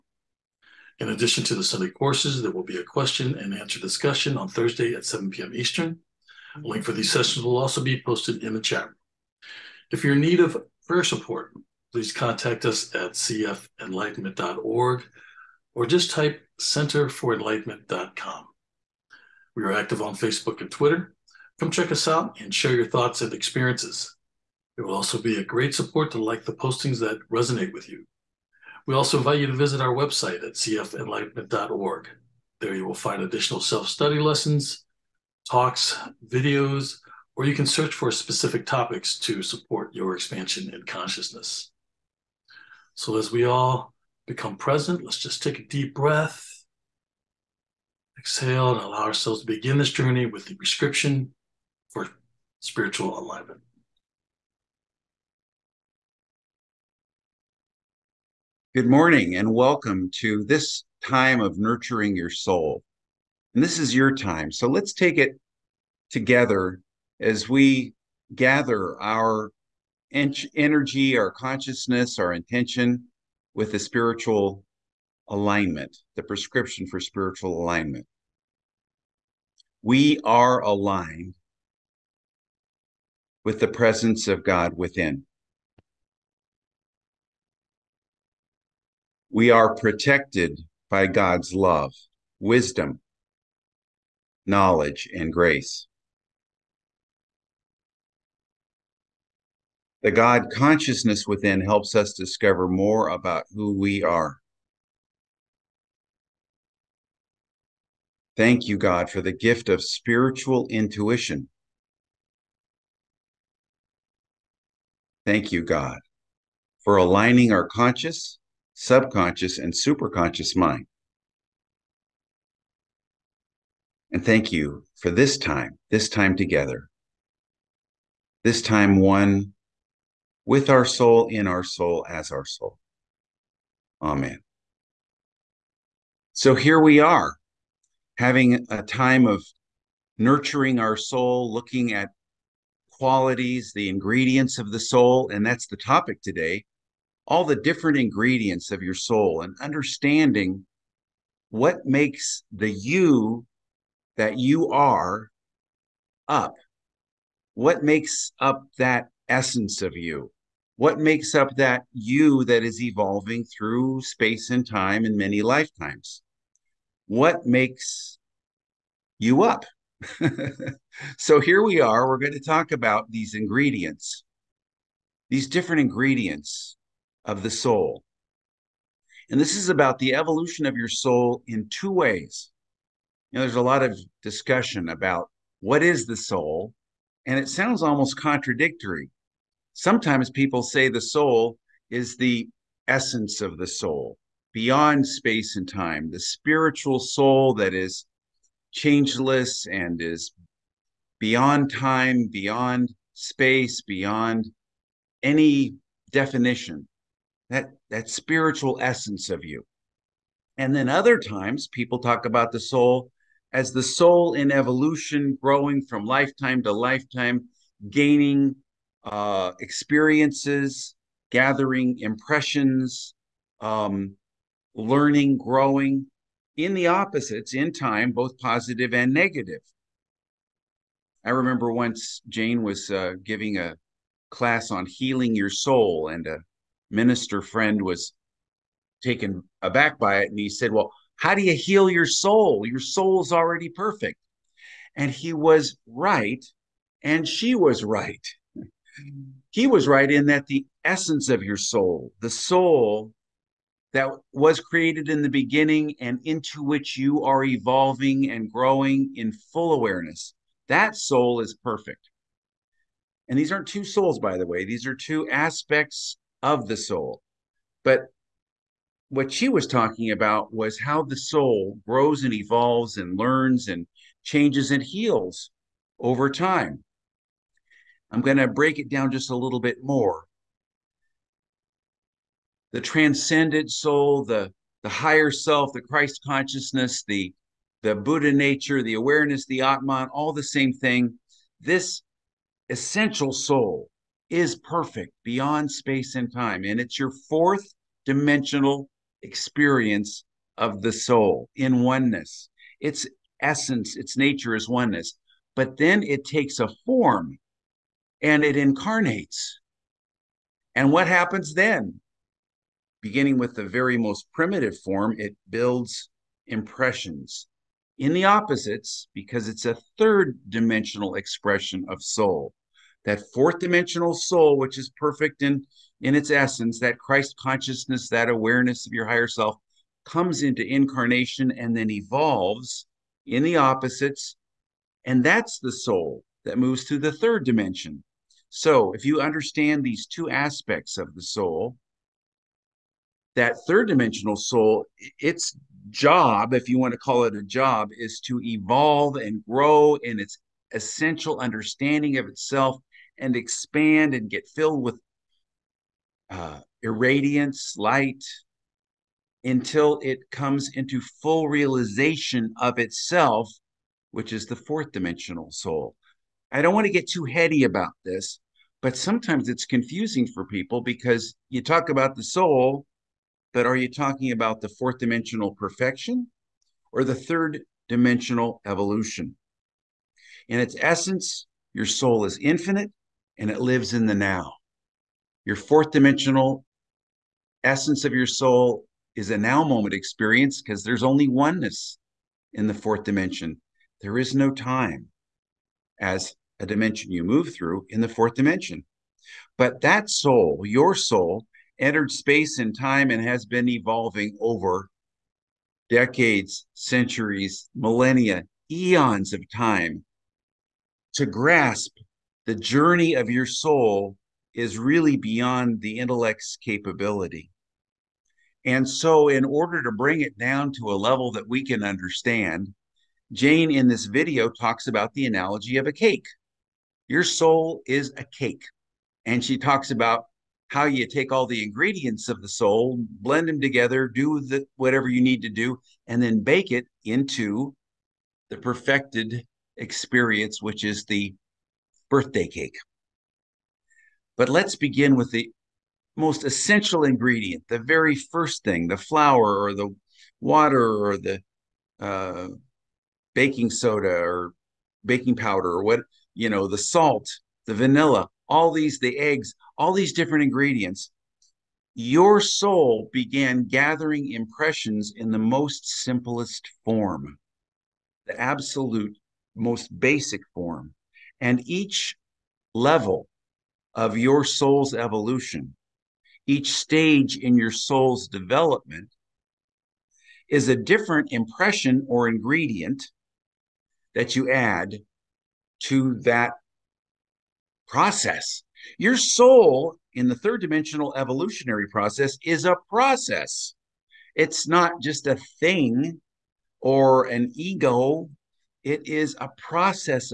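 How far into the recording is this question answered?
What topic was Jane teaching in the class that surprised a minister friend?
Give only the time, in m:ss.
3:54.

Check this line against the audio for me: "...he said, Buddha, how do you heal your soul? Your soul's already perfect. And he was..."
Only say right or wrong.
wrong.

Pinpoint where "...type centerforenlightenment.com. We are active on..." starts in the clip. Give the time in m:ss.
0:16.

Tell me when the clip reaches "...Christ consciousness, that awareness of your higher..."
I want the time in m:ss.
5:26.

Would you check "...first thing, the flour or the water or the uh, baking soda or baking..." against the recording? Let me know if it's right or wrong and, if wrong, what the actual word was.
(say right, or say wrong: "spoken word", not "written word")
right.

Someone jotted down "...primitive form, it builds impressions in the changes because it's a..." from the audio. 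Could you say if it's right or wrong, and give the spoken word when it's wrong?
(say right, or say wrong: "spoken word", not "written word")
wrong: "opposites", not "changes".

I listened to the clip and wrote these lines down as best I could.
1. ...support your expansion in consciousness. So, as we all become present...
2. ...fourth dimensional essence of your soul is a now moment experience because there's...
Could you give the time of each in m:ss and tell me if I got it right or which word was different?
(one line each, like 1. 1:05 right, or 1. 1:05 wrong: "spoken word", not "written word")
1. 0:39 right
2. 6:25 right.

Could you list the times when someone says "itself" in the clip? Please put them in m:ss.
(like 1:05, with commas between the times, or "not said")
5:52, 6:02.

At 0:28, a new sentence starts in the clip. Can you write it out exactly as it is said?
We also invite you to visit our website at cfenlightenment.org.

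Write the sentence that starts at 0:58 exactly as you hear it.
Good morning and welcome to this time of nurturing your soul.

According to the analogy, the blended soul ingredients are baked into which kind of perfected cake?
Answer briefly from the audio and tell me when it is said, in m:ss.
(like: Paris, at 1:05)
birthday cake, at 7:22.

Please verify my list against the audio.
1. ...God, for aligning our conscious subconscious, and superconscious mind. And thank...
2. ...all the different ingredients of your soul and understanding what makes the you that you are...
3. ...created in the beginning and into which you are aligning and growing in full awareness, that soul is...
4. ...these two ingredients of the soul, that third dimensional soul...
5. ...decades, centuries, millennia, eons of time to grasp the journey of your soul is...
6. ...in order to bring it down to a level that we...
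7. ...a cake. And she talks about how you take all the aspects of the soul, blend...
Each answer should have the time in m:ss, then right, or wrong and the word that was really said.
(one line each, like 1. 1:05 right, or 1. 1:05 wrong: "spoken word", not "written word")
1. 1:55 right
2. 2:27 right
3. 4:14 wrong: "evolving", not "aligning"
4. 5:39 wrong: "aspects", not "ingredients"
5. 6:45 right
6. 6:59 right
7. 7:08 wrong: "ingredients", not "aspects".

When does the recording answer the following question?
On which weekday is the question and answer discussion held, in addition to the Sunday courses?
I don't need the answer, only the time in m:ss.
0:04.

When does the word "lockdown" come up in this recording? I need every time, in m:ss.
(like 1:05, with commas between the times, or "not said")
not said.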